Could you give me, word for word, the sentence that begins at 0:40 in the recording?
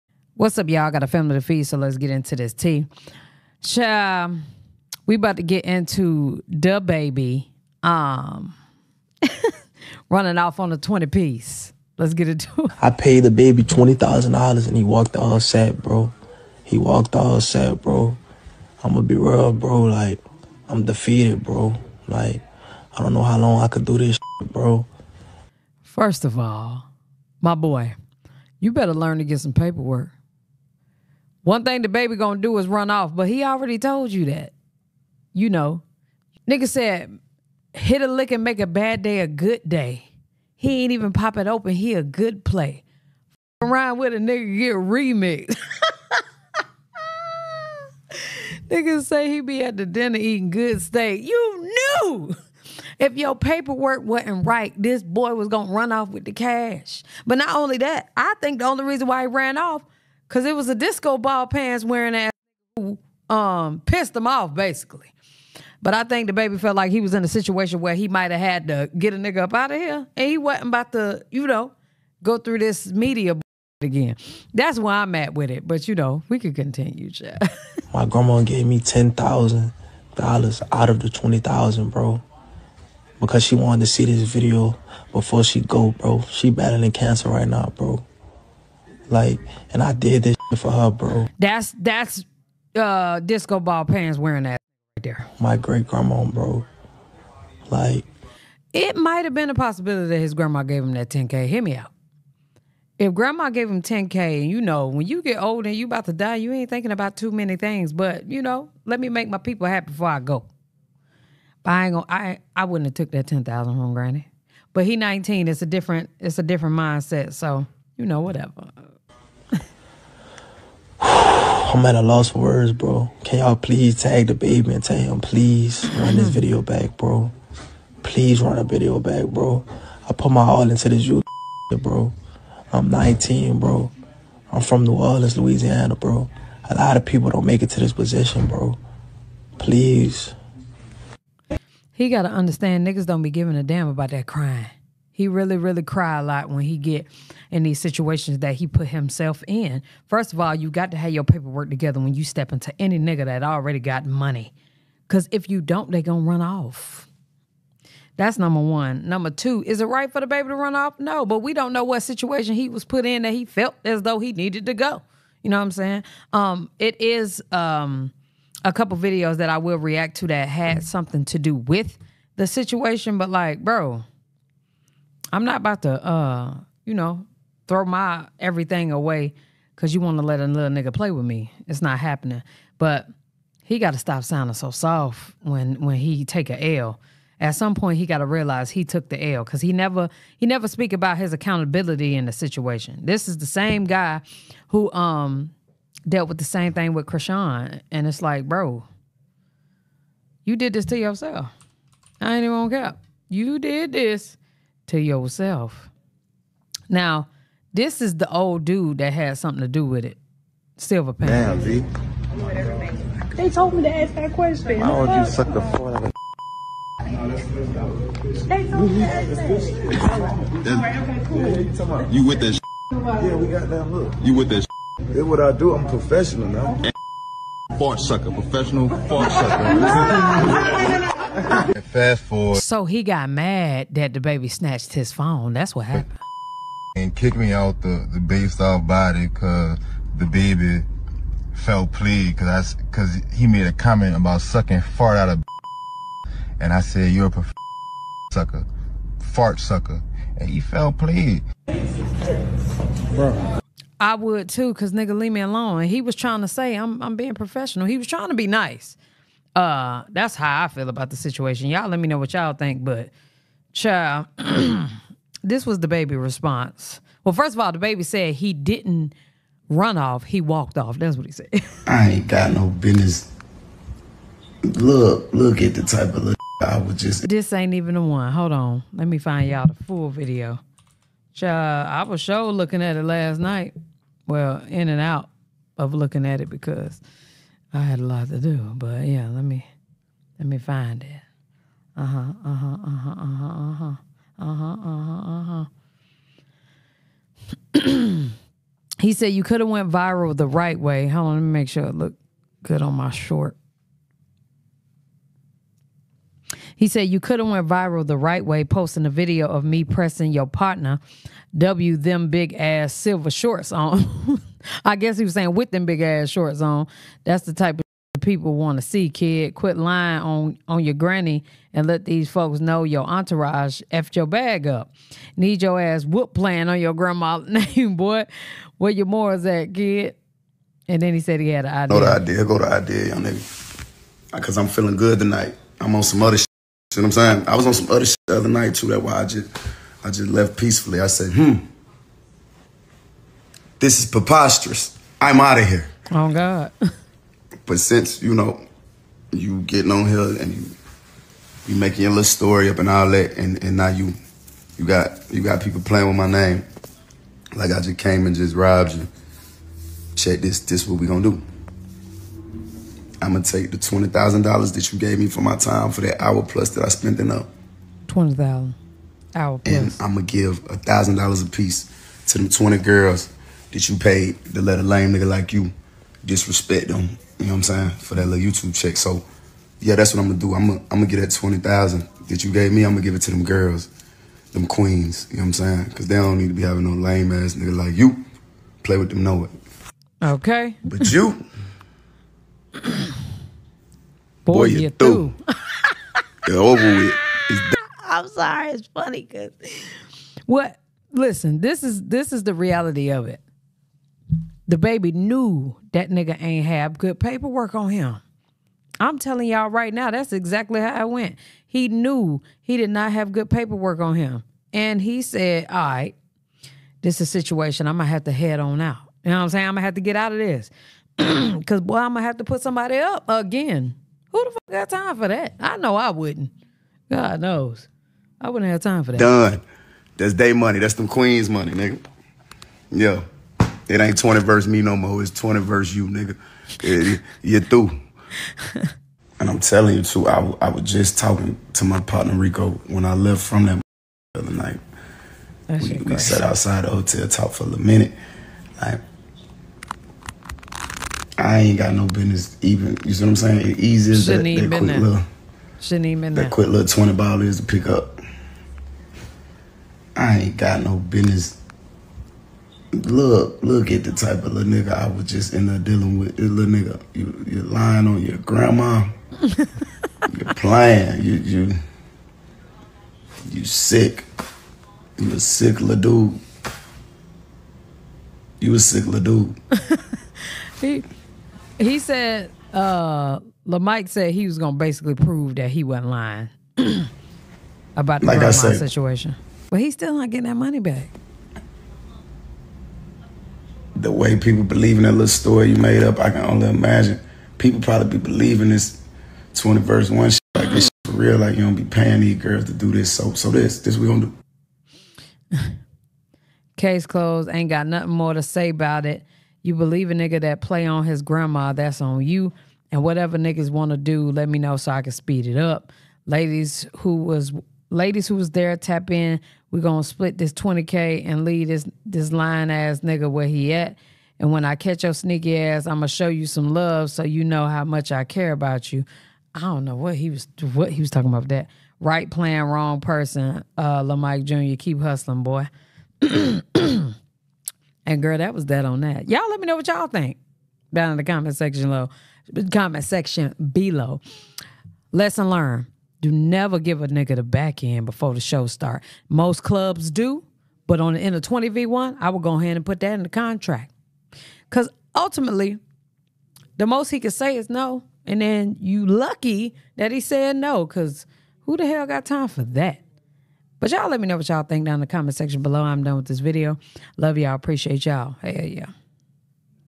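He ain't even pop it open.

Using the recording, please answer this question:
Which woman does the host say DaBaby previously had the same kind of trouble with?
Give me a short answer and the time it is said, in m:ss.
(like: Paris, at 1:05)
Chrisean, at 3:17.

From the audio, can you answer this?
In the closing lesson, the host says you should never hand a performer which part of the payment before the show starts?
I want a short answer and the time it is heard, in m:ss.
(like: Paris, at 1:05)
The back end, at 9:07.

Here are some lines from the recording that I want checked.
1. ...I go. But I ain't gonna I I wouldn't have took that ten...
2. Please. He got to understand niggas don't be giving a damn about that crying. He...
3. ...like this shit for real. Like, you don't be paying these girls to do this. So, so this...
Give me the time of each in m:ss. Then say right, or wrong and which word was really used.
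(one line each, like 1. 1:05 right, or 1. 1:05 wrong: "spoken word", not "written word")
1. 1:50 right
2. 2:19 right
3. 8:20 right.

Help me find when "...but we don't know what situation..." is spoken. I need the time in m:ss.
2:41.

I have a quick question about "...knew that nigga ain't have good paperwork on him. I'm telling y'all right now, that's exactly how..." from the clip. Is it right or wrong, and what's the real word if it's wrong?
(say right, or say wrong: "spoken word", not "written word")
right.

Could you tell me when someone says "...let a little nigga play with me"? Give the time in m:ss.
3:00.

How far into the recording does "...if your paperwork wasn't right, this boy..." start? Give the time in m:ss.
0:52.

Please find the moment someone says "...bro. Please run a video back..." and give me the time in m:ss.
2:06.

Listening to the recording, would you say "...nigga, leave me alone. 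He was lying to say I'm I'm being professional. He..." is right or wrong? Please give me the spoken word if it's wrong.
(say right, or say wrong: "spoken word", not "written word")
wrong: "trying", not "lying".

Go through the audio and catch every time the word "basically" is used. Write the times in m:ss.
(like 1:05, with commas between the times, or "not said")
1:04, 8:04.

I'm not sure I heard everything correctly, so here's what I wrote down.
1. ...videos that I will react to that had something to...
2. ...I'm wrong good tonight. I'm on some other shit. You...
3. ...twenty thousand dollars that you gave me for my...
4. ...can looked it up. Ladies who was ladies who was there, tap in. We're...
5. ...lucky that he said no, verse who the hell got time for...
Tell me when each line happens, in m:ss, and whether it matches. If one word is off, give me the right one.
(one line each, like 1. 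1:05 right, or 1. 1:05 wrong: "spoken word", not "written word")
1. 2:48 right
2. 5:34 wrong: "feeling", not "wrong"
3. 6:03 right
4. 8:35 wrong: "speed", not "looked"
5. 9:19 wrong: "cause", not "verse".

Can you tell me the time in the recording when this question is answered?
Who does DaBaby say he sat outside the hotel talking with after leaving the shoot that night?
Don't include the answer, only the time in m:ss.
7:22.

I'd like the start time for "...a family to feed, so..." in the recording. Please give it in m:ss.
0:01.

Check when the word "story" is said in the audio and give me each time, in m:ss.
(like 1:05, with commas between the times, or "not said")
5:52, 8:15.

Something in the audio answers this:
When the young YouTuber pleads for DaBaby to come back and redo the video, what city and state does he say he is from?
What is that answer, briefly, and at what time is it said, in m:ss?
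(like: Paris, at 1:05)
New Orleans, Louisiana, at 2:14.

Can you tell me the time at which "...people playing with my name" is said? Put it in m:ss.
5:55.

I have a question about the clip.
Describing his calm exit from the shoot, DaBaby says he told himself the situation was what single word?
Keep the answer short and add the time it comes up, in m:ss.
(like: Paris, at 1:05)
Preposterous, at 5:44.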